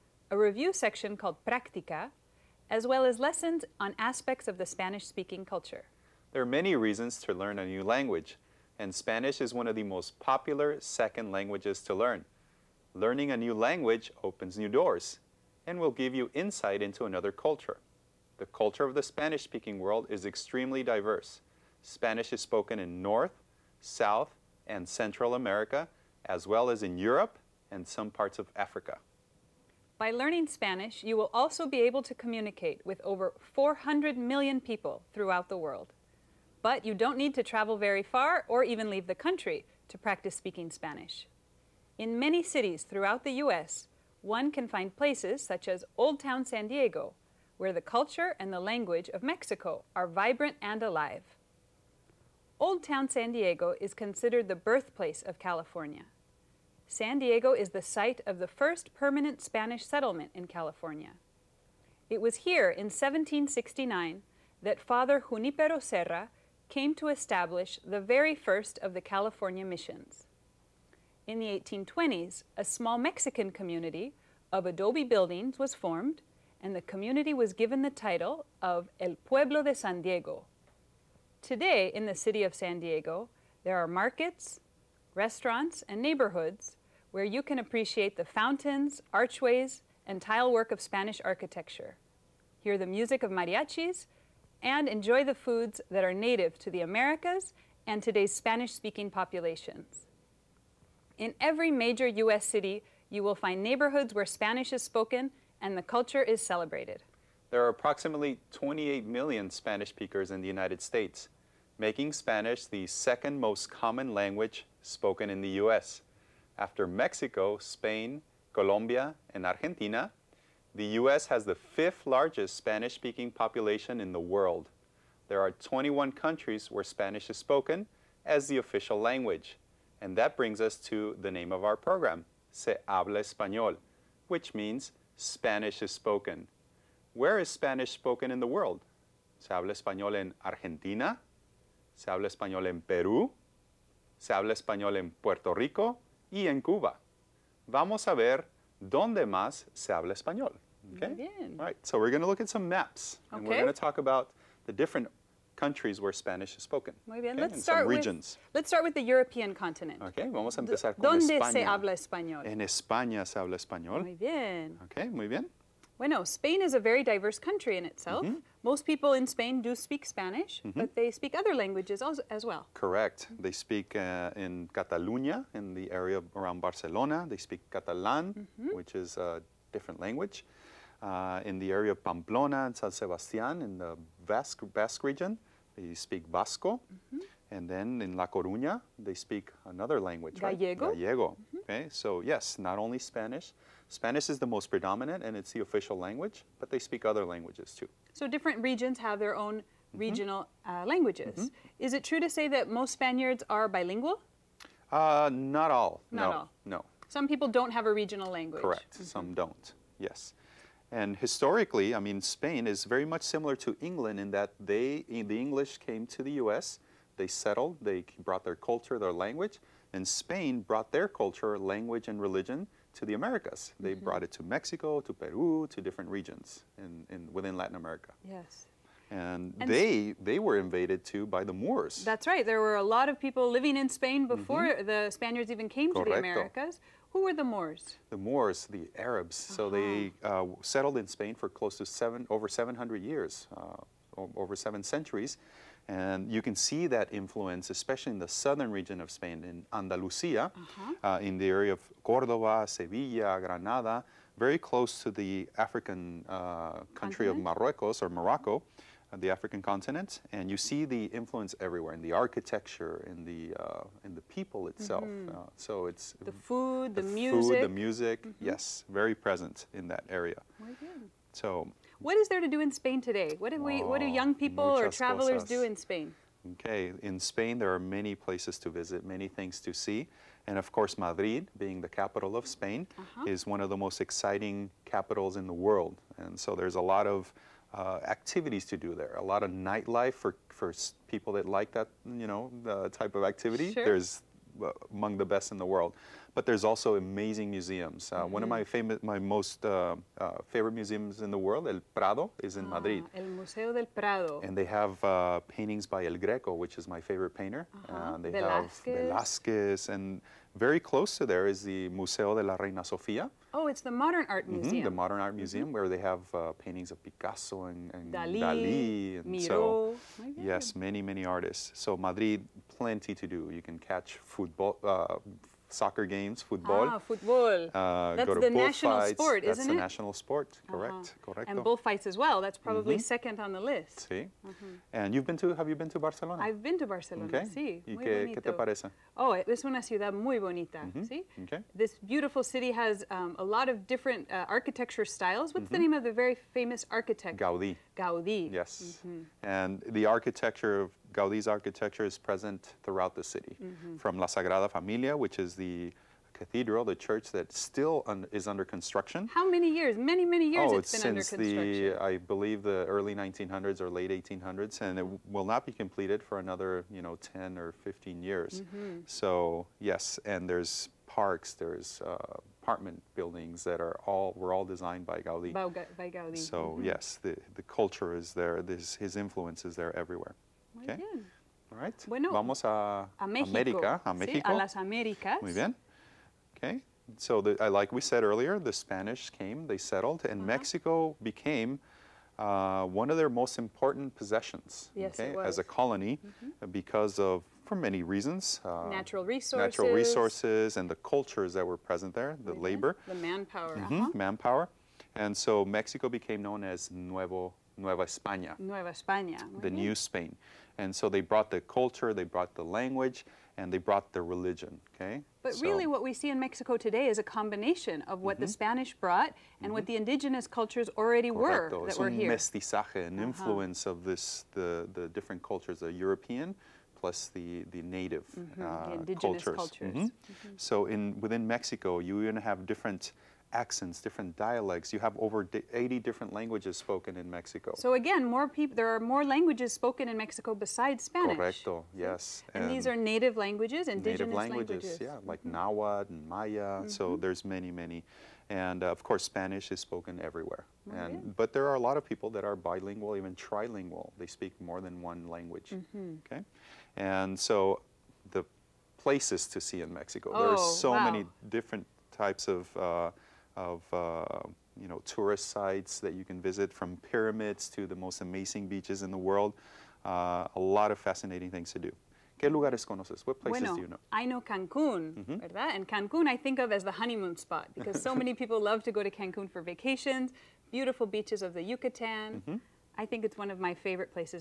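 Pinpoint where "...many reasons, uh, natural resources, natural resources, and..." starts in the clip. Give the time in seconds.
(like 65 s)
397 s.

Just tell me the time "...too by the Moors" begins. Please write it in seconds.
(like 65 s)
231 s.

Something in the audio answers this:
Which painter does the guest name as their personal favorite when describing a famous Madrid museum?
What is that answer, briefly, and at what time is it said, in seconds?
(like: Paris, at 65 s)
El Greco, at 306 s.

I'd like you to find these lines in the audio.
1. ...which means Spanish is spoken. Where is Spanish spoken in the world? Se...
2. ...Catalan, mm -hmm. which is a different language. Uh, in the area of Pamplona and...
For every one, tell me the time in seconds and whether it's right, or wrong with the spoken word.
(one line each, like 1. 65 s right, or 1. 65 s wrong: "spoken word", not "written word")
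1. 134 s right
2. 177 s right.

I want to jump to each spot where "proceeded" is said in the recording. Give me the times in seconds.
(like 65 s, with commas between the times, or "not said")
not said.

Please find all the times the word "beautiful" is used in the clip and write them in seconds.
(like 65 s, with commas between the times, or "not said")
342 s, 480 s.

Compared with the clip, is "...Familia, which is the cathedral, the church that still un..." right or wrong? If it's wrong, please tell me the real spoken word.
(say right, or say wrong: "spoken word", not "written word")
right.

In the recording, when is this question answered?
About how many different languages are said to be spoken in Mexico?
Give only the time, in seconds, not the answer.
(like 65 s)
435 s.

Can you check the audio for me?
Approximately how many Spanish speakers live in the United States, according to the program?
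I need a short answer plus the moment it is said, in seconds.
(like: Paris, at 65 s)
28 million, at 108 s.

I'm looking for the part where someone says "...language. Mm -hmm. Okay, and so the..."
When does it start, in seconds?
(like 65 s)
455 s.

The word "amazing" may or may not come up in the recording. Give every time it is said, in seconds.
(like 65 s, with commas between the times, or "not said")
297 s, 468 s.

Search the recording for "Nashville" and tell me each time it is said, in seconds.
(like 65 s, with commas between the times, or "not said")
not said.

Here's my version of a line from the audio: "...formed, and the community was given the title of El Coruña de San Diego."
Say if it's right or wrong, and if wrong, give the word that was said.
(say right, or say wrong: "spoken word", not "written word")
wrong: "Pueblo", not "Coruña".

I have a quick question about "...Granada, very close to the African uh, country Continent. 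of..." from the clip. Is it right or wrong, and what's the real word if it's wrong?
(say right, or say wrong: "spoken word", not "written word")
right.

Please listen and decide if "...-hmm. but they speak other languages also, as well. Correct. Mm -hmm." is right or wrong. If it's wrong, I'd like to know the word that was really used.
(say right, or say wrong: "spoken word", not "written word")
right.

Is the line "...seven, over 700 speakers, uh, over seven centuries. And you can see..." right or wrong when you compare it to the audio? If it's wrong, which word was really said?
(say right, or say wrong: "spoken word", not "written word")
wrong: "years", not "speakers".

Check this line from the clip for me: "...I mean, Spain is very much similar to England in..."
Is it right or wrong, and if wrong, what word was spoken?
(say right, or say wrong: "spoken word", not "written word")
right.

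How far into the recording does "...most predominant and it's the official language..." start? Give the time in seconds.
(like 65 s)
194 s.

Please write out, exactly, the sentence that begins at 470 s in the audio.
Uh, a lot of fascinating things to do.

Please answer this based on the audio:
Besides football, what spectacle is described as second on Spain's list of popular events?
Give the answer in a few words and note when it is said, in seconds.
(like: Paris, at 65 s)
Bullfights, at 331 s.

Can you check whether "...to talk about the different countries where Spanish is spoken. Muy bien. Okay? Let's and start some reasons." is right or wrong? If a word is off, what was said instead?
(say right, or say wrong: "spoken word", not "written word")
wrong: "regions", not "reasons".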